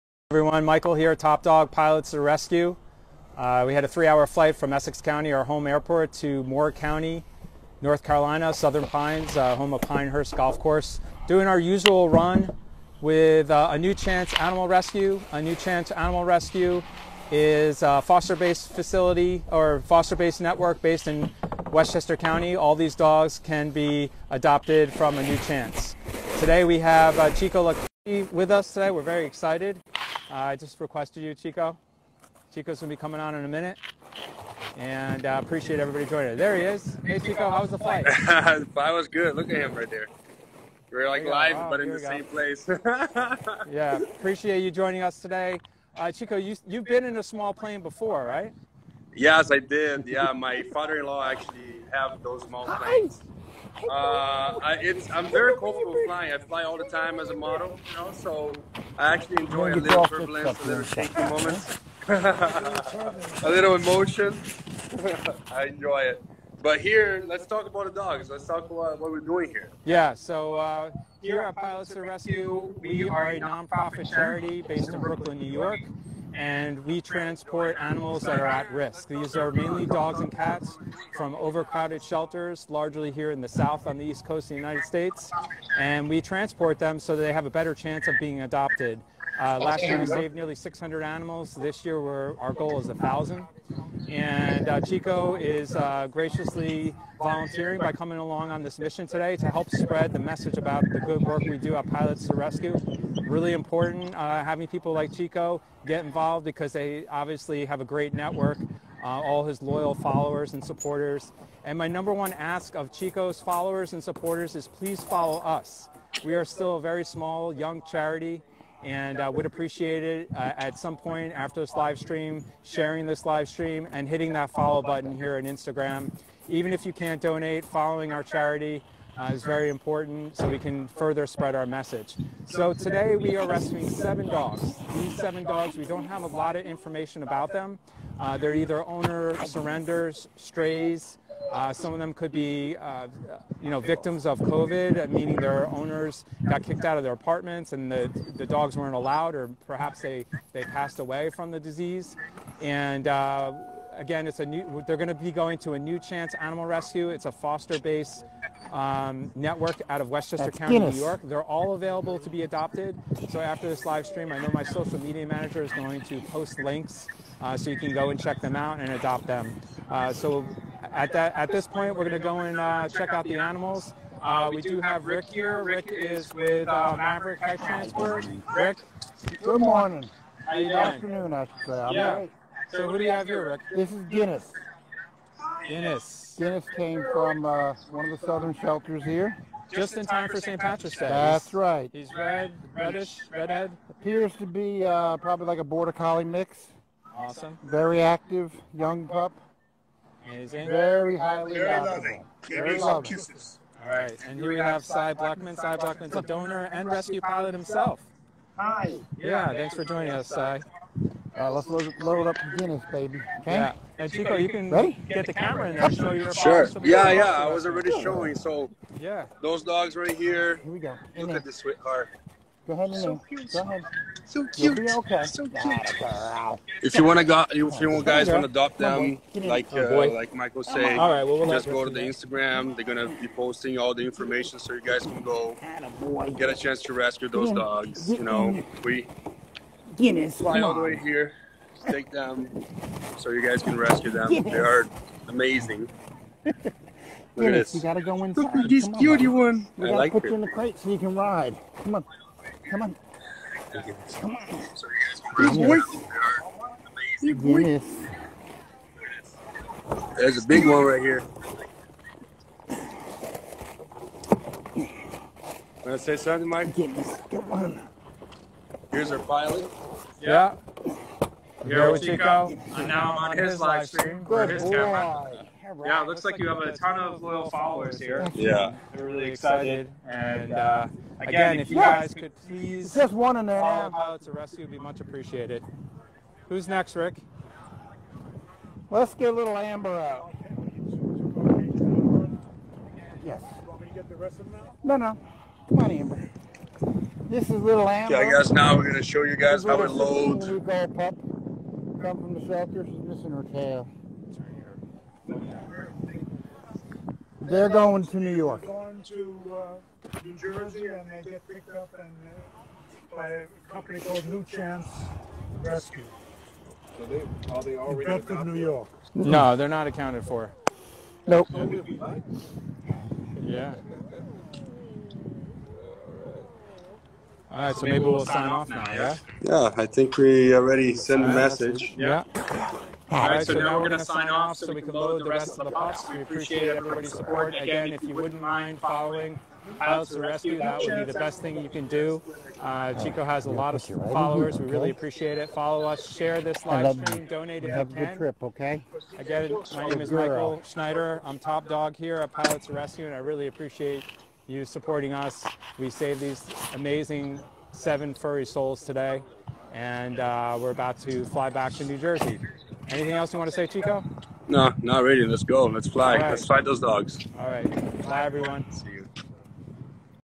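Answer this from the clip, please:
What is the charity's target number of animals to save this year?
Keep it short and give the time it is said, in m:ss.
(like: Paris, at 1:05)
1,000, at 1:32.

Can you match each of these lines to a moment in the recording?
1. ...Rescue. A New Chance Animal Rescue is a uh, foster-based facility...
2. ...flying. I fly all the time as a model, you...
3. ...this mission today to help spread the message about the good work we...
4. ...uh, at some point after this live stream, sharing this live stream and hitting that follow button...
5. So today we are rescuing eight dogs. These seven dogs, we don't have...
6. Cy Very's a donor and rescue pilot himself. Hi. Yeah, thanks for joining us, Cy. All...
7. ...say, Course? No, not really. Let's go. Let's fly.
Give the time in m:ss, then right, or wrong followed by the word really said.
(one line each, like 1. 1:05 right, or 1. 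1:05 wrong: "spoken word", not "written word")
1. 0:14 right
2. 0:56 right
3. 1:38 right
4. 2:00 right
5. 2:12 wrong: "seven", not "eight"
6. 3:25 wrong: "Blackman", not "Very"
7. 6:03 wrong: "Chico", not "Course".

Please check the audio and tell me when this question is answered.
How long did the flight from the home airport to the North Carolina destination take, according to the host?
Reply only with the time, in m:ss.
0:03.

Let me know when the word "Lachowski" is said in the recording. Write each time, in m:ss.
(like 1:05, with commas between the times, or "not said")
0:27.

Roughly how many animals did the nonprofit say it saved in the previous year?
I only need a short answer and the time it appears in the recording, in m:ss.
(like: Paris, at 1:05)
nearly 600, at 1:30.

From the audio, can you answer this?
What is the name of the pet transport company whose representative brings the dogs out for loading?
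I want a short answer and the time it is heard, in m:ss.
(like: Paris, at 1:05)
Maverick Pet Transport, at 2:56.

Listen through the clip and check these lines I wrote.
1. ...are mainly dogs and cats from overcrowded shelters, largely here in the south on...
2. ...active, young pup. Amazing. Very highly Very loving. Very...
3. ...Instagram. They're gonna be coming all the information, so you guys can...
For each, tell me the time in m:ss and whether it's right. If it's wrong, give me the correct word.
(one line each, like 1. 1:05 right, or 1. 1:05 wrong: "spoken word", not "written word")
1. 1:19 right
2. 3:18 right
3. 3:52 wrong: "posting", not "coming".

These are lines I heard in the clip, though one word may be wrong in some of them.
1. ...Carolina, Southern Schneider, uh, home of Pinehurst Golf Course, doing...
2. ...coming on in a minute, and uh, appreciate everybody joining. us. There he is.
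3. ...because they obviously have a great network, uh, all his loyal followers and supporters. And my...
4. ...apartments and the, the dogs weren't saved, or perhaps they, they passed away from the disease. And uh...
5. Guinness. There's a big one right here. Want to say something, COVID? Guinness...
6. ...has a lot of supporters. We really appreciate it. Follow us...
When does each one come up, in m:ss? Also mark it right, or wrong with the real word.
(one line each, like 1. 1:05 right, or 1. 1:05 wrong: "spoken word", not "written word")
1. 0:08 wrong: "Pines", not "Schneider"
2. 0:32 right
3. 1:46 right
4. 2:27 wrong: "allowed", not "saved"
5. 4:17 wrong: "Mike", not "COVID"
6. 5:43 wrong: "followers", not "supporters".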